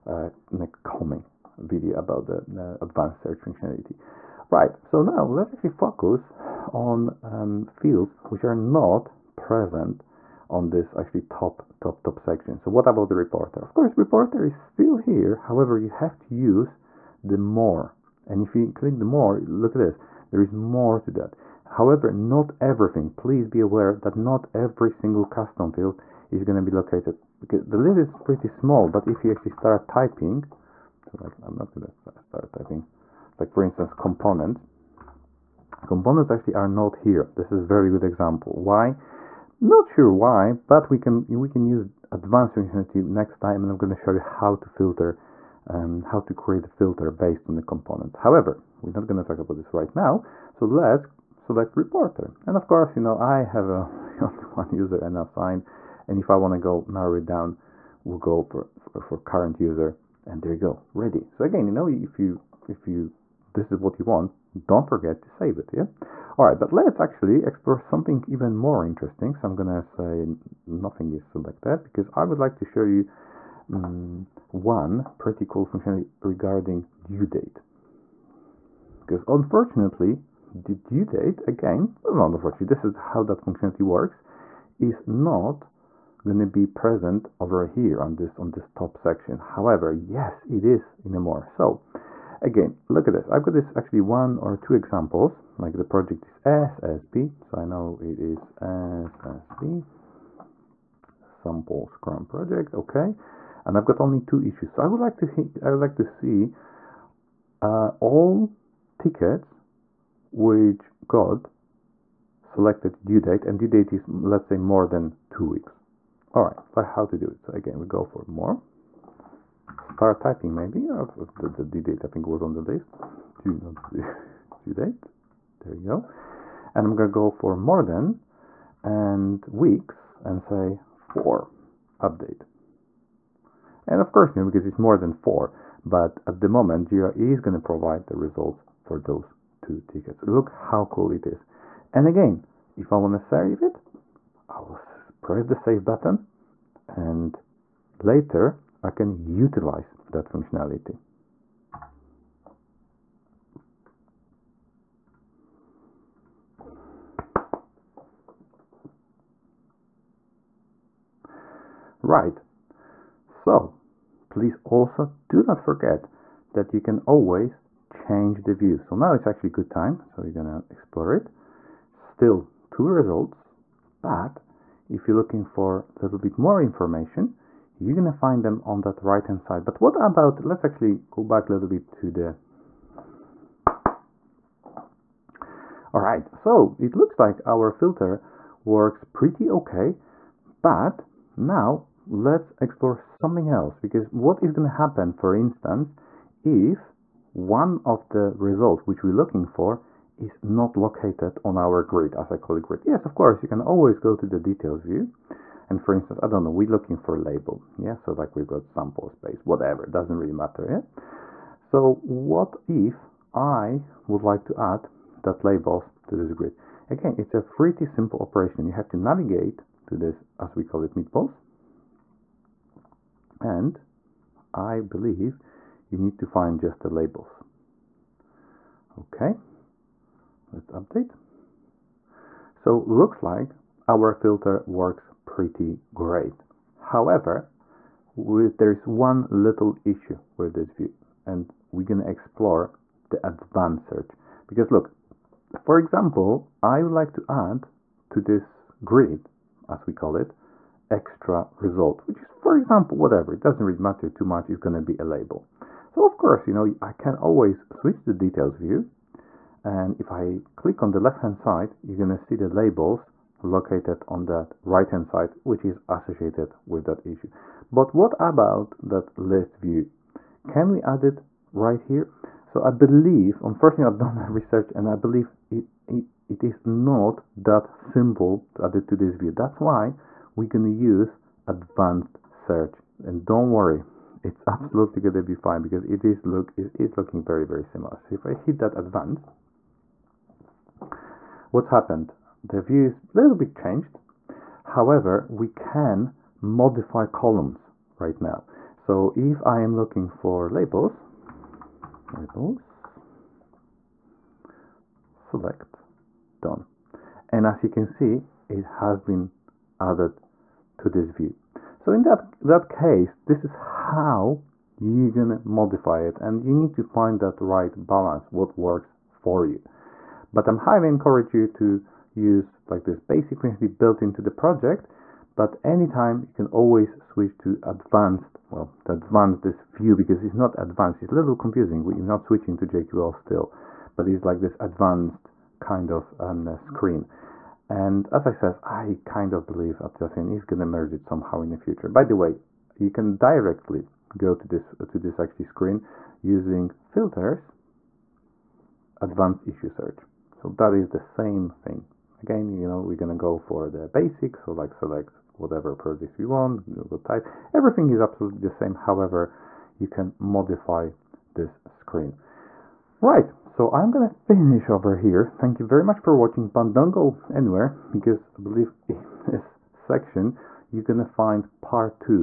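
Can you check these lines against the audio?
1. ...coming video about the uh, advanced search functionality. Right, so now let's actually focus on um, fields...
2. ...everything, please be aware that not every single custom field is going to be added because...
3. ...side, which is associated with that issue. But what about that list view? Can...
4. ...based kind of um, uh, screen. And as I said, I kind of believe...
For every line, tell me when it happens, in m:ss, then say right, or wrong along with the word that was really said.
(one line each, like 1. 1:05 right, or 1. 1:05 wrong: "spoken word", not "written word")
1. 0:00 right
2. 0:22 wrong: "located", not "added"
3. 4:25 right
4. 5:34 wrong: "advanced", not "based".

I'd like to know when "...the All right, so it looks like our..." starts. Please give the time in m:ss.
3:02.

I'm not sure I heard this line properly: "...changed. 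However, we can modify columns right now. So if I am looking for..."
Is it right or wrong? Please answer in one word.
right.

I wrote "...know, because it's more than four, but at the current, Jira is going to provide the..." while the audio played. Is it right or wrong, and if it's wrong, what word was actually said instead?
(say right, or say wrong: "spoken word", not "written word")
wrong: "moment", not "current".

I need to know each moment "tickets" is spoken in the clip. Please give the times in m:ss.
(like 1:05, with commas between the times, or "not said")
1:48, 2:19.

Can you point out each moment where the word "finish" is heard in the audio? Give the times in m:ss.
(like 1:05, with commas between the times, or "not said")
6:04.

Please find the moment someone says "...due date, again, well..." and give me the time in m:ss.
1:20.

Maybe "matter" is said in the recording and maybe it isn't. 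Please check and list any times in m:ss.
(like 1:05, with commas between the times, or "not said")
3:30, 4:13.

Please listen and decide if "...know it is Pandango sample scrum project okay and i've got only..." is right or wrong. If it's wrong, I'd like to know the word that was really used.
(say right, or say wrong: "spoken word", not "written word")
wrong: "SSB", not "Pandango".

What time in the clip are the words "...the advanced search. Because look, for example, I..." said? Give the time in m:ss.
4:03.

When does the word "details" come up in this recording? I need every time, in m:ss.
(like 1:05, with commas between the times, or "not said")
3:24, 4:18.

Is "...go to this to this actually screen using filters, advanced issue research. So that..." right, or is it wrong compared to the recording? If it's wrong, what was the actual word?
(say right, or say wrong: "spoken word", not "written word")
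wrong: "search", not "research".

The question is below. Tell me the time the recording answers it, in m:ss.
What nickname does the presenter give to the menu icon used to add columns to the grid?
3:40.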